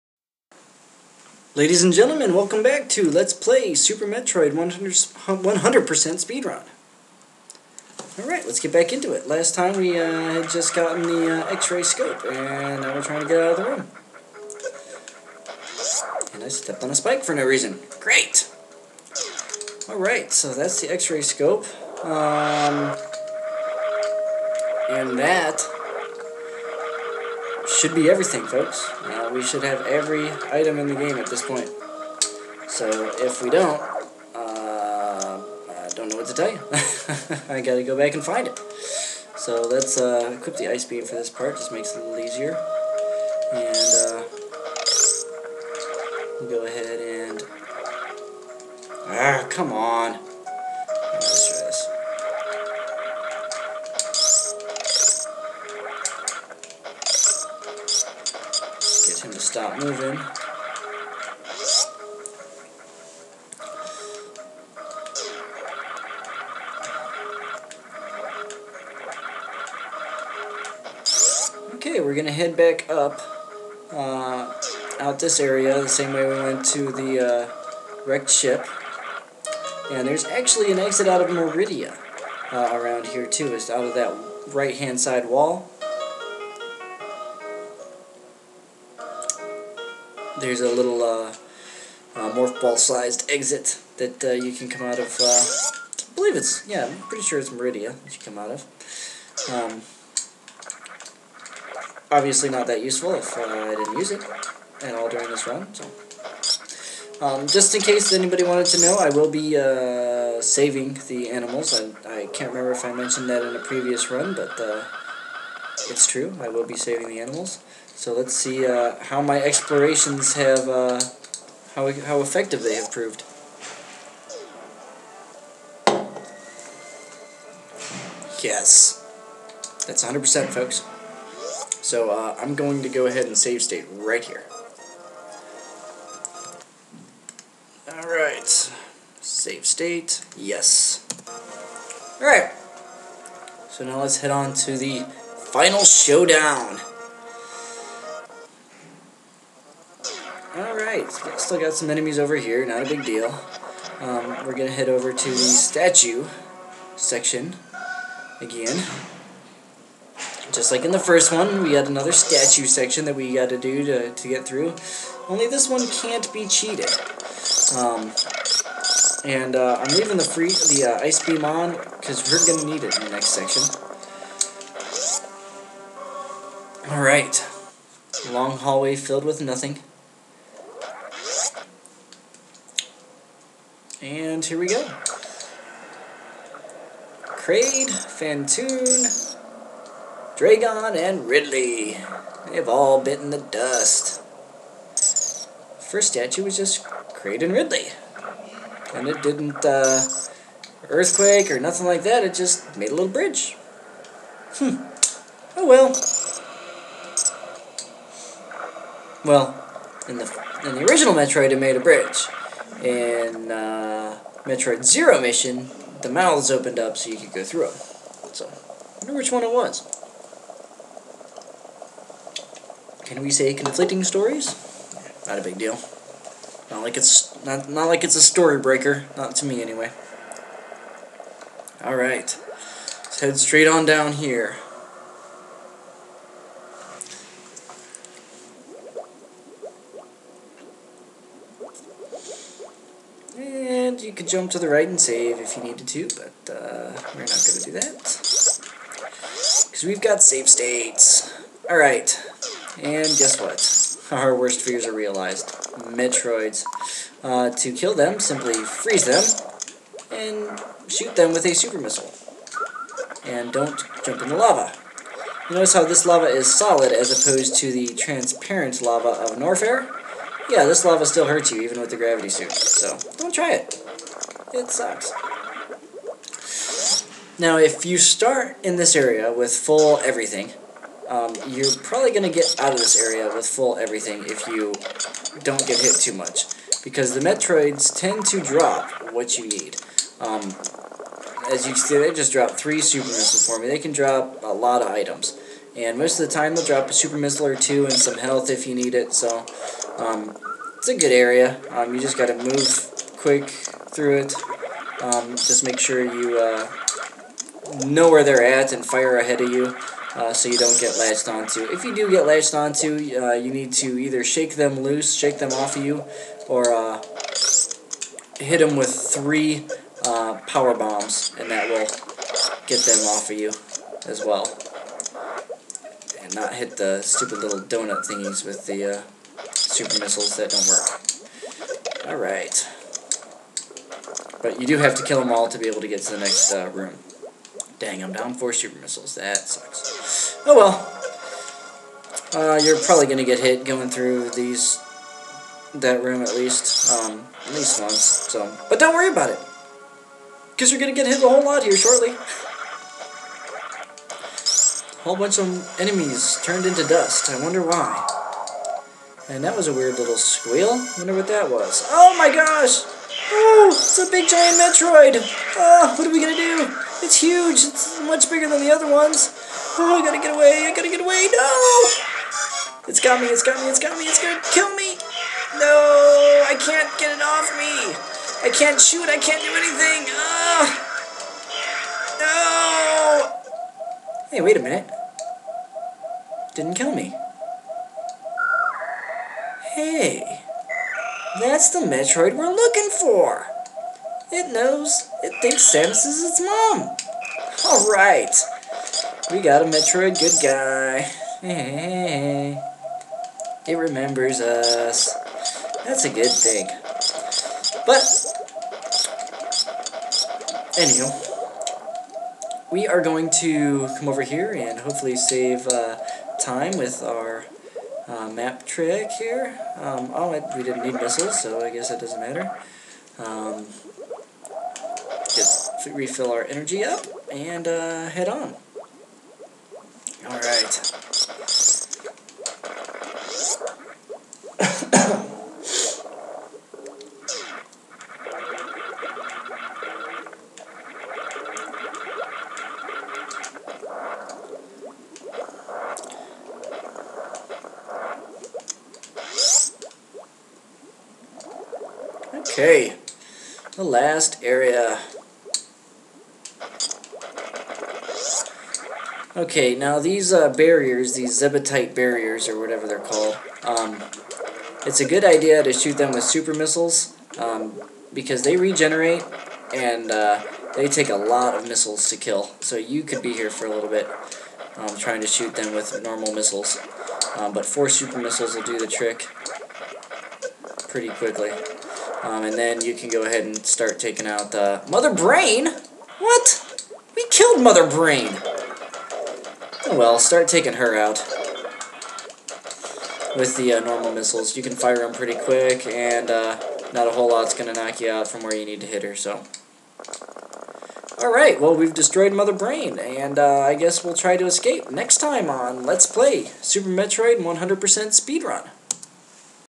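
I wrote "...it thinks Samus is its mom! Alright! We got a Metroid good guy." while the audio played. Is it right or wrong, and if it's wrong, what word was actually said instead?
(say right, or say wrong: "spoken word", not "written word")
right.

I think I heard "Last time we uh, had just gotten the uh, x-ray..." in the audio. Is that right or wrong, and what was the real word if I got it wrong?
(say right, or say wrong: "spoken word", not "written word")
right.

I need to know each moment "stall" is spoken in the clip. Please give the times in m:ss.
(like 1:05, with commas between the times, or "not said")
not said.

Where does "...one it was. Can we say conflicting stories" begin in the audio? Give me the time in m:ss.
3:39.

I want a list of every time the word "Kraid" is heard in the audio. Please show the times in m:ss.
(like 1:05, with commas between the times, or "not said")
3:07, 3:17.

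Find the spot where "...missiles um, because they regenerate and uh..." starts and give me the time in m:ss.
7:46.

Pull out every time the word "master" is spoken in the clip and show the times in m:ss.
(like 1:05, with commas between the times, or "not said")
not said.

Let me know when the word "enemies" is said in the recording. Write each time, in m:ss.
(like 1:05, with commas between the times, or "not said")
2:31, 5:55.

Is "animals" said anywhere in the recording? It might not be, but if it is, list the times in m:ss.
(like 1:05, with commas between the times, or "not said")
1:51, 1:57.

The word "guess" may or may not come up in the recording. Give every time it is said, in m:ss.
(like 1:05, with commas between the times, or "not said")
4:13, 7:01, 8:23.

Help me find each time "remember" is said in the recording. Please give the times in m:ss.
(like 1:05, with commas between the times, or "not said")
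1:52, 6:43.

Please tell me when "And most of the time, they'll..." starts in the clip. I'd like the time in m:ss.
4:55.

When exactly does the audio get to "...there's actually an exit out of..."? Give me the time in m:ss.
1:20.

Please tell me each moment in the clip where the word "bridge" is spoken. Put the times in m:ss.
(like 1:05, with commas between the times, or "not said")
3:23, 3:31.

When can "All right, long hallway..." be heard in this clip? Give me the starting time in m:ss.
2:56.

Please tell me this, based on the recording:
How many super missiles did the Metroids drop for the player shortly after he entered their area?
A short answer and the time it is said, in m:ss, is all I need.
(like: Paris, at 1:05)
3, at 4:52.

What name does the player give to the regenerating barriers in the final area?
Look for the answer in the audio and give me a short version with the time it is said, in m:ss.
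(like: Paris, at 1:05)
Zebetite barriers, at 7:41.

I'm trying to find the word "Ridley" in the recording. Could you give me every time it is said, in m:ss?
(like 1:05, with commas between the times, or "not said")
3:11, 3:17.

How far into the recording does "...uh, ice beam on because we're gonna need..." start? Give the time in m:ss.
2:50.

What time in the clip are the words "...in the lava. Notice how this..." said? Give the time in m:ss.
4:24.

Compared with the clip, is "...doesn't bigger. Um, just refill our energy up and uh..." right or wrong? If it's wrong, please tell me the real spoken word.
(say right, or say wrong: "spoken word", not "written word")
wrong: "matter", not "bigger".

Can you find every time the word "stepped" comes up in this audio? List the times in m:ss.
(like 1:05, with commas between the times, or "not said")
0:16.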